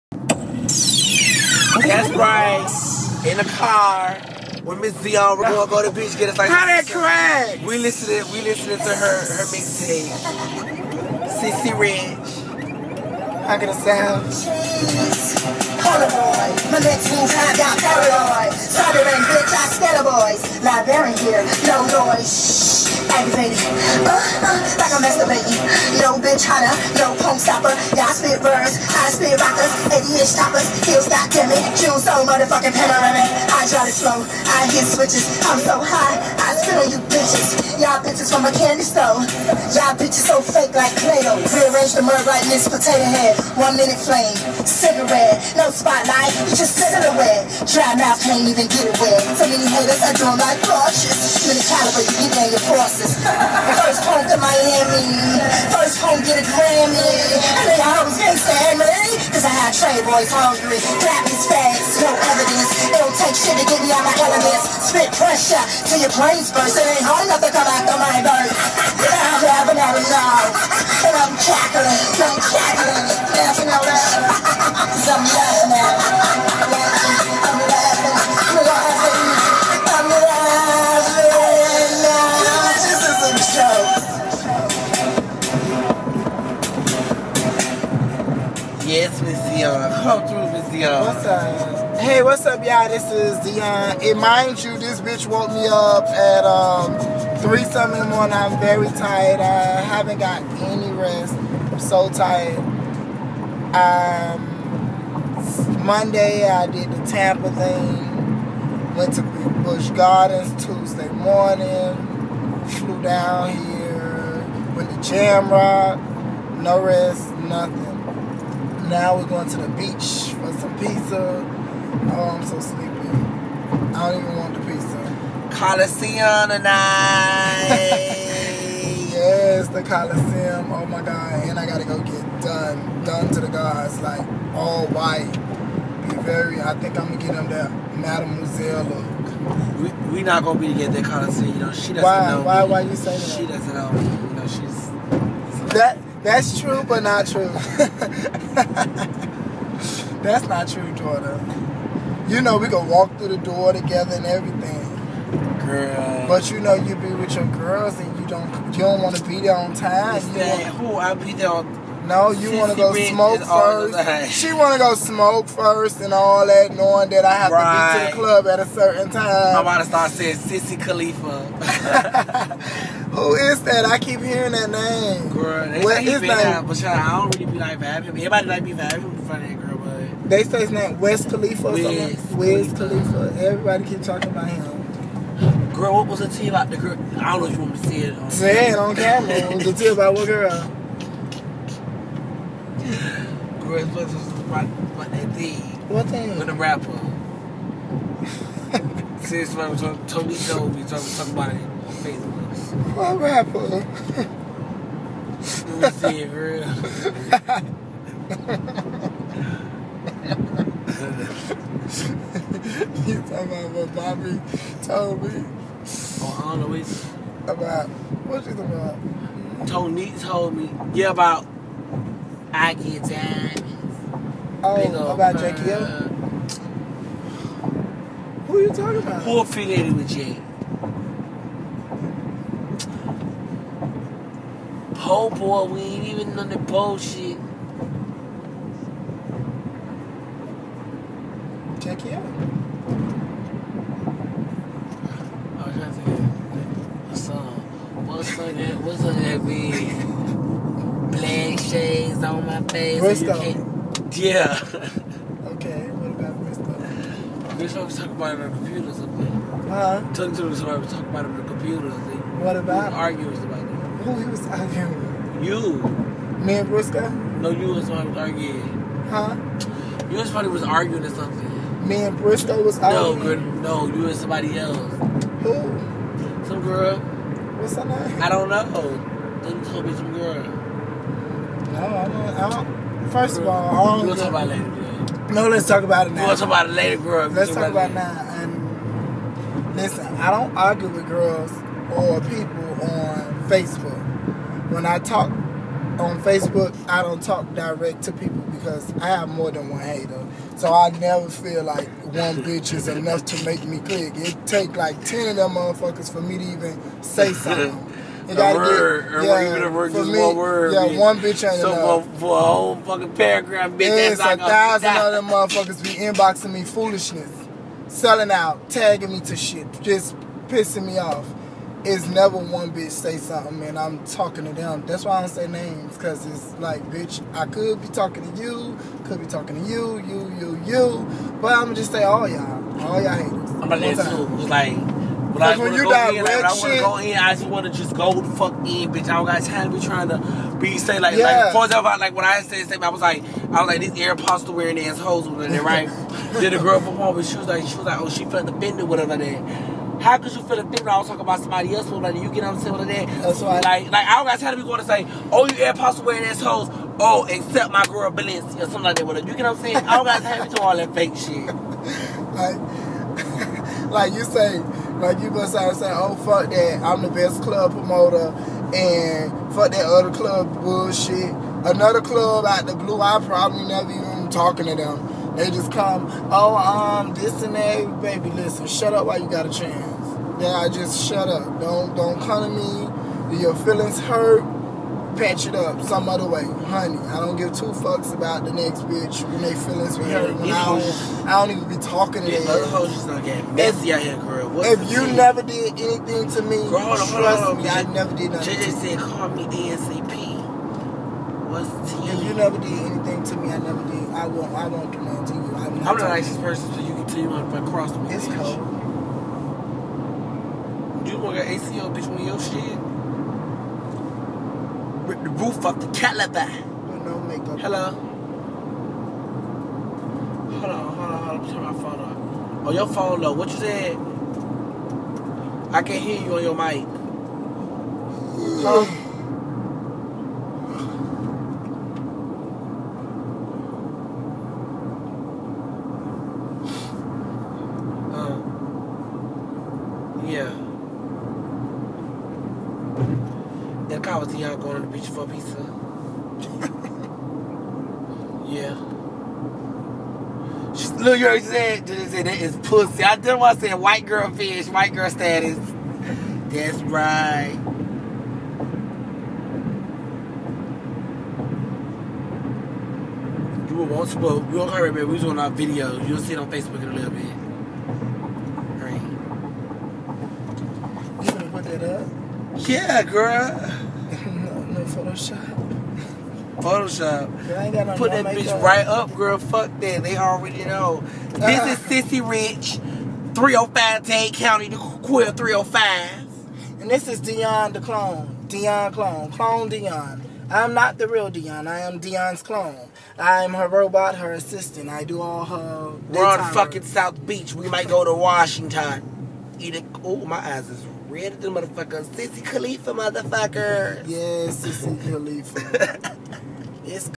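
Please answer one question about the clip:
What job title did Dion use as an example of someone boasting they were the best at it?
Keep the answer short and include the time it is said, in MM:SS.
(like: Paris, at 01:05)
Club promoter, at 06:07.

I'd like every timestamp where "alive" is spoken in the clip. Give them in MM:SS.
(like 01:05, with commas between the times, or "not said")
not said.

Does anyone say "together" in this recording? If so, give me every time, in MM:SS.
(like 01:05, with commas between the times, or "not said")
02:20, 02:33.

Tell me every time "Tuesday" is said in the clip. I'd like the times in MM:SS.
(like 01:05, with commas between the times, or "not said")
01:50.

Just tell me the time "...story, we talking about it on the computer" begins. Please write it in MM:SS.
04:20.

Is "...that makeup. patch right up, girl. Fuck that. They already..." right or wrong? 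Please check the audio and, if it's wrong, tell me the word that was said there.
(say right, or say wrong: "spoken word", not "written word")
wrong: "bitch", not "patch".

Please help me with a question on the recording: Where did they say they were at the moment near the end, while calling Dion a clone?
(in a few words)
South Beach.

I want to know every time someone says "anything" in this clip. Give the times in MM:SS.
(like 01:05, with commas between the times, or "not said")
06:35, 06:42.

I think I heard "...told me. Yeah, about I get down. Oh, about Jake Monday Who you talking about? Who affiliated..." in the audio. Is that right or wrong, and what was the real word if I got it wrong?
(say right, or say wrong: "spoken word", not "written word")
wrong: "Who", not "Monday".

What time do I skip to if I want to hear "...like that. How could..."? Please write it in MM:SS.
05:49.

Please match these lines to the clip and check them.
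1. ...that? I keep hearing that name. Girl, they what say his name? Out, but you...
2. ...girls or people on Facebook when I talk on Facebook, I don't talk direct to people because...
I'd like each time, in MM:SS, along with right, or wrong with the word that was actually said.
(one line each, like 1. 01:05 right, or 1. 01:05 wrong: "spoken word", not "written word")
1. 02:53 right
2. 04:51 right.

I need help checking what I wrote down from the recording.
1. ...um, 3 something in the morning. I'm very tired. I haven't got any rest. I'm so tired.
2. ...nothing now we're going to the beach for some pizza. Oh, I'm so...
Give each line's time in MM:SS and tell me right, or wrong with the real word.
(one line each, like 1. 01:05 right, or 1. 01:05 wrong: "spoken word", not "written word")
1. 01:36 right
2. 01:57 right.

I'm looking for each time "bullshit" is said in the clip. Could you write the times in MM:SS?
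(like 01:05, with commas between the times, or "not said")
03:56, 06:10.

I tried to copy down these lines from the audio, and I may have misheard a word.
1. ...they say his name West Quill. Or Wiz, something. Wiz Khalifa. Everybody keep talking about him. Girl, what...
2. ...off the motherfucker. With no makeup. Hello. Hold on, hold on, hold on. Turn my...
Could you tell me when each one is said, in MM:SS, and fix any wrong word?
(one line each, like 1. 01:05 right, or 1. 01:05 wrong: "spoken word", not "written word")
1. 03:00 wrong: "Khalifa", not "Quill"
2. 06:55 wrong: "caliber", not "motherfucker".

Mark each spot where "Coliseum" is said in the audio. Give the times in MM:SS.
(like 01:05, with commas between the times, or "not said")
02:05, 02:09, 02:21.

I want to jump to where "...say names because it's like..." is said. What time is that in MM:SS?
05:25.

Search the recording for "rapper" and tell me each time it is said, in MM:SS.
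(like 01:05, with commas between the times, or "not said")
03:16, 03:23.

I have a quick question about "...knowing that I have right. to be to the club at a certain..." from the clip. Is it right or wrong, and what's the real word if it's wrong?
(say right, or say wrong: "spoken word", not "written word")
right.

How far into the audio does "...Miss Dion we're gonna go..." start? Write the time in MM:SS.
00:04.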